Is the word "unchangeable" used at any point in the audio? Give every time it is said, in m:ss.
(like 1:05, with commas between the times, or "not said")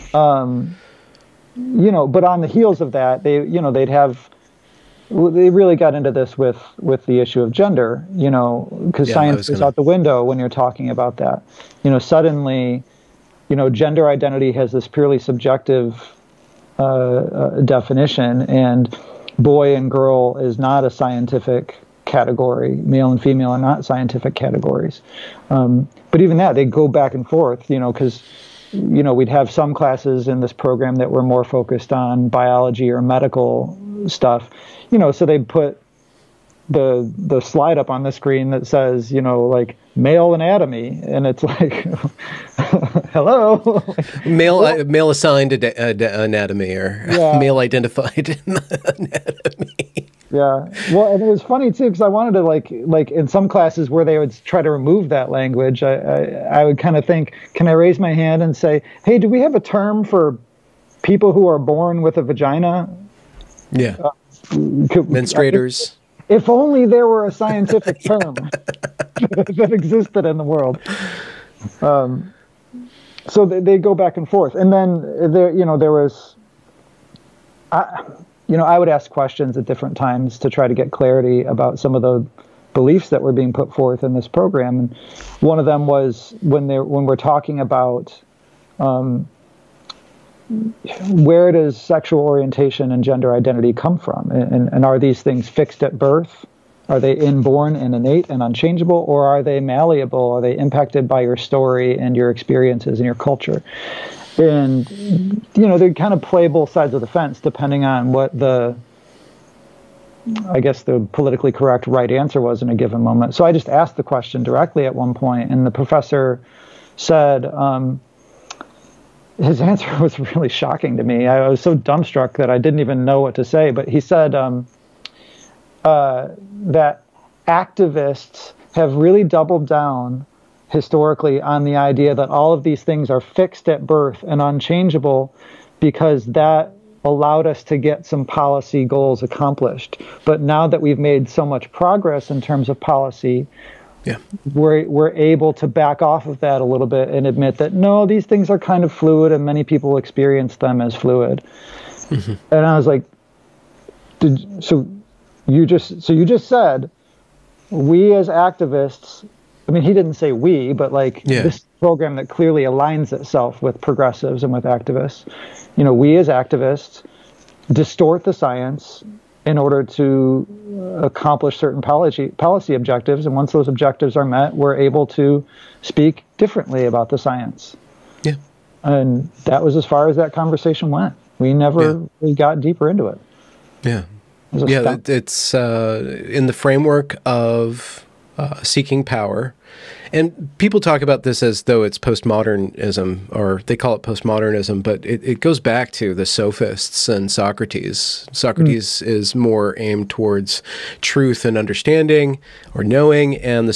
1:38, 2:14.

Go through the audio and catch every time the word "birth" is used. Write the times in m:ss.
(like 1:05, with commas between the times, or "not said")
1:35, 2:13.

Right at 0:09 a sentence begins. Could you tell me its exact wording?
is out the window when you're talking about that.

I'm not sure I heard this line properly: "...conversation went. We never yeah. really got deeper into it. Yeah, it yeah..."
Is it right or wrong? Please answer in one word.
right.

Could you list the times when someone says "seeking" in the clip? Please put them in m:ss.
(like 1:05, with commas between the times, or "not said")
3:08.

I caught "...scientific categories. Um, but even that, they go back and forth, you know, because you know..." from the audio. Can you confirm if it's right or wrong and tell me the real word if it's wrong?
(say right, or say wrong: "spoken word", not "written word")
right.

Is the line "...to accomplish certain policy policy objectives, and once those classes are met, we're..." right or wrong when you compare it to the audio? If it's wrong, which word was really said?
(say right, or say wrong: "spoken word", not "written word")
wrong: "objectives", not "classes".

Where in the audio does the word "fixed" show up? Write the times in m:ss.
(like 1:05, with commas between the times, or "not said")
1:35, 2:13.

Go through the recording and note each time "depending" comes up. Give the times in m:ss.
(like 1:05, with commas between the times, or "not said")
1:47.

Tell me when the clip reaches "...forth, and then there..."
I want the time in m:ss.
1:14.